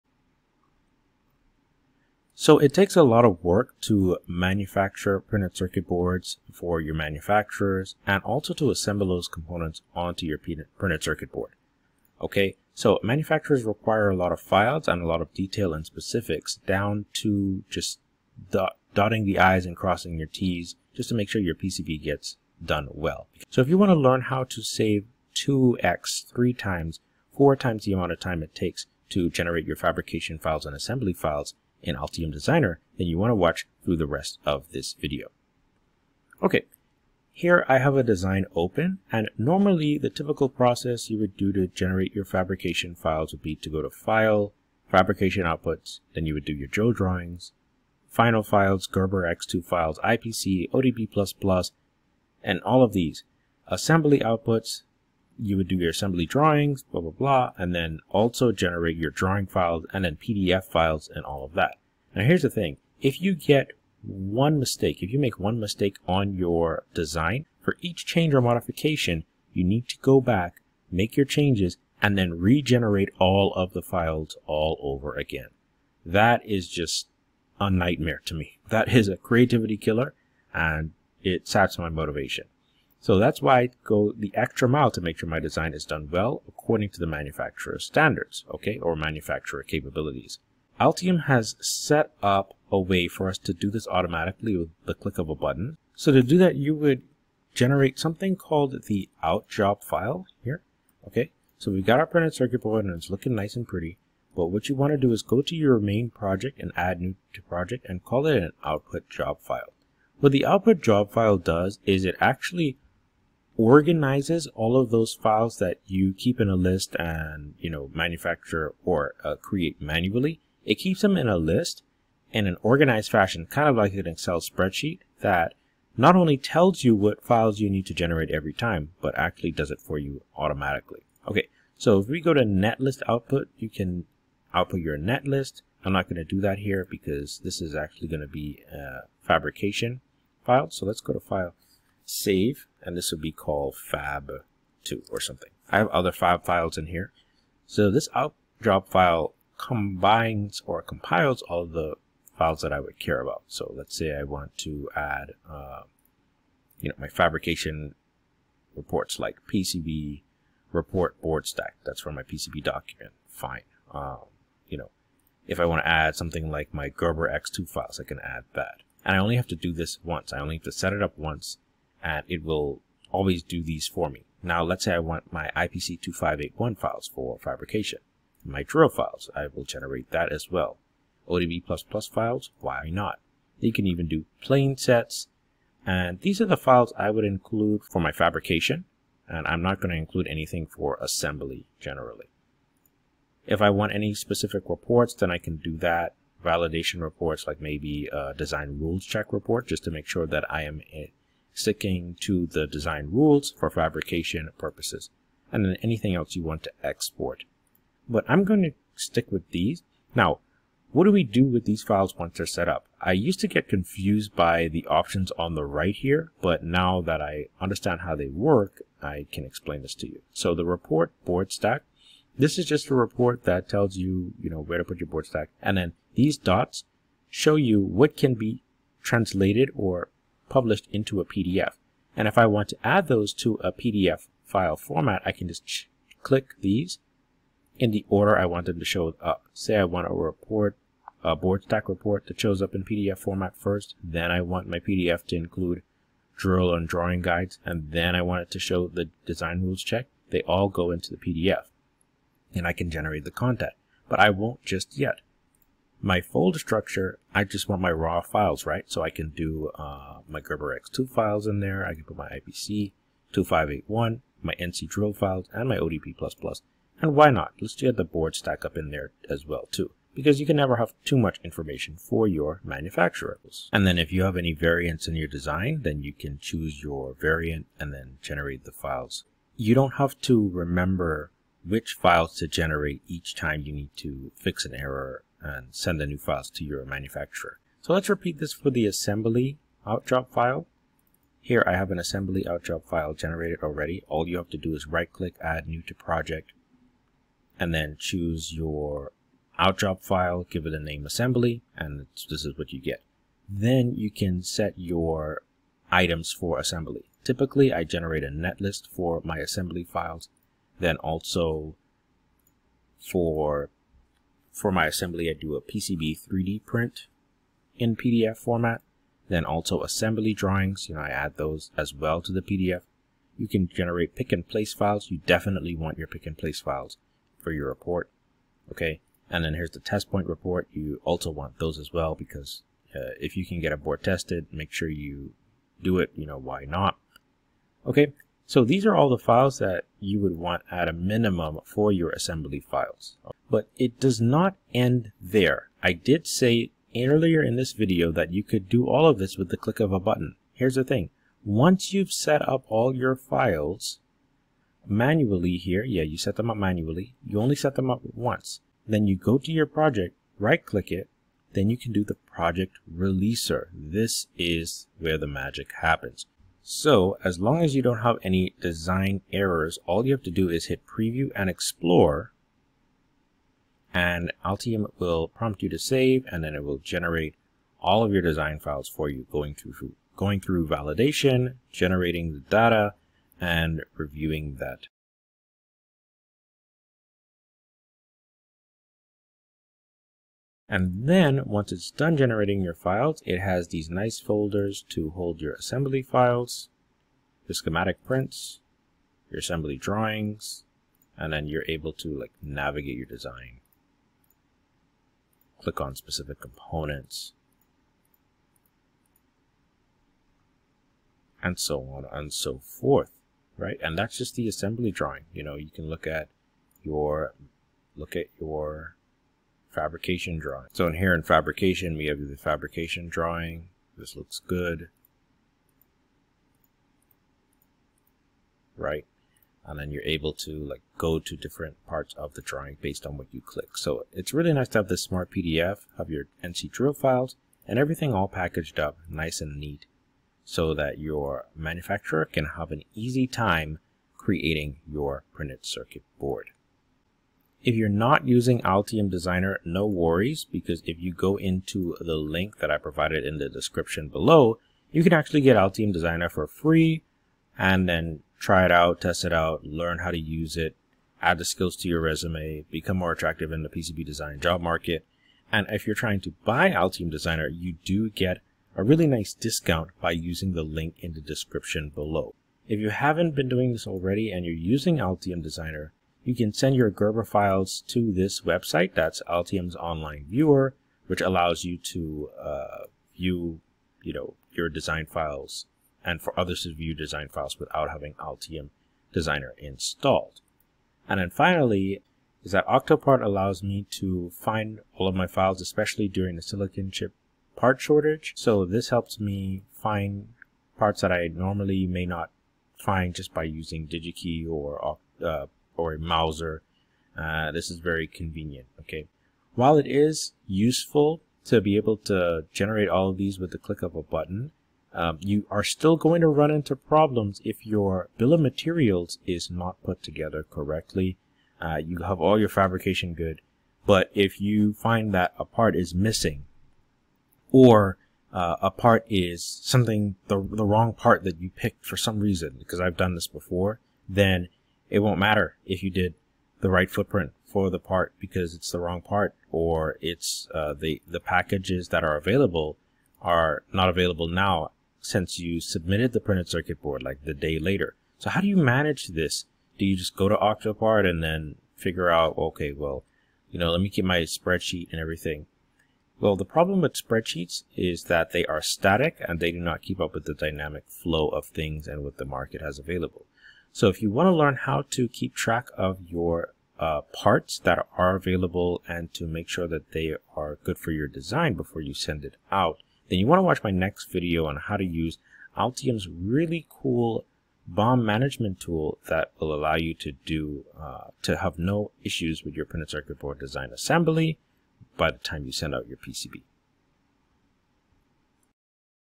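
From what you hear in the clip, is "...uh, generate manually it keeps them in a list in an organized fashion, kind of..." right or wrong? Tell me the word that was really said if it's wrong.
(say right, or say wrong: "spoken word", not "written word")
wrong: "create", not "generate".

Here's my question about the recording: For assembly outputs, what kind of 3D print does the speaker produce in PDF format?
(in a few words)
PCB 3D print.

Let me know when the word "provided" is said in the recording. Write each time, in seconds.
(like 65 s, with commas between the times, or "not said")
452 s.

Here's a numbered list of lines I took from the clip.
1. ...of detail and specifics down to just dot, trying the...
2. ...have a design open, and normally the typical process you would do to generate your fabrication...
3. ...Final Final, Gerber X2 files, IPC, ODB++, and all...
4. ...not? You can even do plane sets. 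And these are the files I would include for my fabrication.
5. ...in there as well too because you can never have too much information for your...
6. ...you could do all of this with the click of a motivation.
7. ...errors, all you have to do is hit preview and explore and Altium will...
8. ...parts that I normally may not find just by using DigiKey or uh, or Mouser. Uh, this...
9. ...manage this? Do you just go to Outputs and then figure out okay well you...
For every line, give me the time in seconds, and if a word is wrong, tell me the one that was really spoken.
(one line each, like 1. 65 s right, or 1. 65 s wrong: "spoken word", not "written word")
1. 15 s wrong: "dotting", not "trying"
2. 37 s right
3. 48 s wrong: "Files", not "Final"
4. 182 s right
5. 268 s right
6. 348 s wrong: "button", not "motivation"
7. 369 s right
8. 500 s right
9. 548 s wrong: "Octopart", not "Outputs".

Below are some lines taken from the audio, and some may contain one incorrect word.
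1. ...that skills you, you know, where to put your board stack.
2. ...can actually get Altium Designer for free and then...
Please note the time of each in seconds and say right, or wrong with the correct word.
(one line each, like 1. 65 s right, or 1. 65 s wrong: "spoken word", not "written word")
1. 223 s wrong: "tells", not "skills"
2. 455 s right.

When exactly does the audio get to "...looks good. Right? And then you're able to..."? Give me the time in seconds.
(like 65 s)
424 s.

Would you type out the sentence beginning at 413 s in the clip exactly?
And that's just the assembly drawing.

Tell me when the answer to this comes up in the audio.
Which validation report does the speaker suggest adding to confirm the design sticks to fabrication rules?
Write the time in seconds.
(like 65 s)
198 s.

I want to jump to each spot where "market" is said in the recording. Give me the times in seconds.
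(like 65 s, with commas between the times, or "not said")
464 s, 562 s.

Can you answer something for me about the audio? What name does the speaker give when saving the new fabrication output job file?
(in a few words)
fab2.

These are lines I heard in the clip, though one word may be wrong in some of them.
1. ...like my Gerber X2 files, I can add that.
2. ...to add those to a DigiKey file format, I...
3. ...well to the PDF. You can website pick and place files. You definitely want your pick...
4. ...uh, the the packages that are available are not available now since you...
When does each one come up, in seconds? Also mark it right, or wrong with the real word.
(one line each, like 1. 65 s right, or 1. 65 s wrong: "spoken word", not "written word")
1. 166 s right
2. 232 s wrong: "PDF", not "DigiKey"
3. 321 s wrong: "generate", not "website"
4. 540 s right.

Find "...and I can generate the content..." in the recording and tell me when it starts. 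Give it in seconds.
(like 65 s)
252 s.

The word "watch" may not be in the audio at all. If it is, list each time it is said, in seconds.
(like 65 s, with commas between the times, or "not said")
33 s, 573 s.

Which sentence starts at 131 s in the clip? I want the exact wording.
Okay, so if we go to netlist output, you can output your netlist.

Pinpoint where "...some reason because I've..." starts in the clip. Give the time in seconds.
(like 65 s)
531 s.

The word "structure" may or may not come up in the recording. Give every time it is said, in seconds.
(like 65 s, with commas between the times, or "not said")
256 s.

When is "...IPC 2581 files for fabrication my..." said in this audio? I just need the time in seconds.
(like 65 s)
175 s.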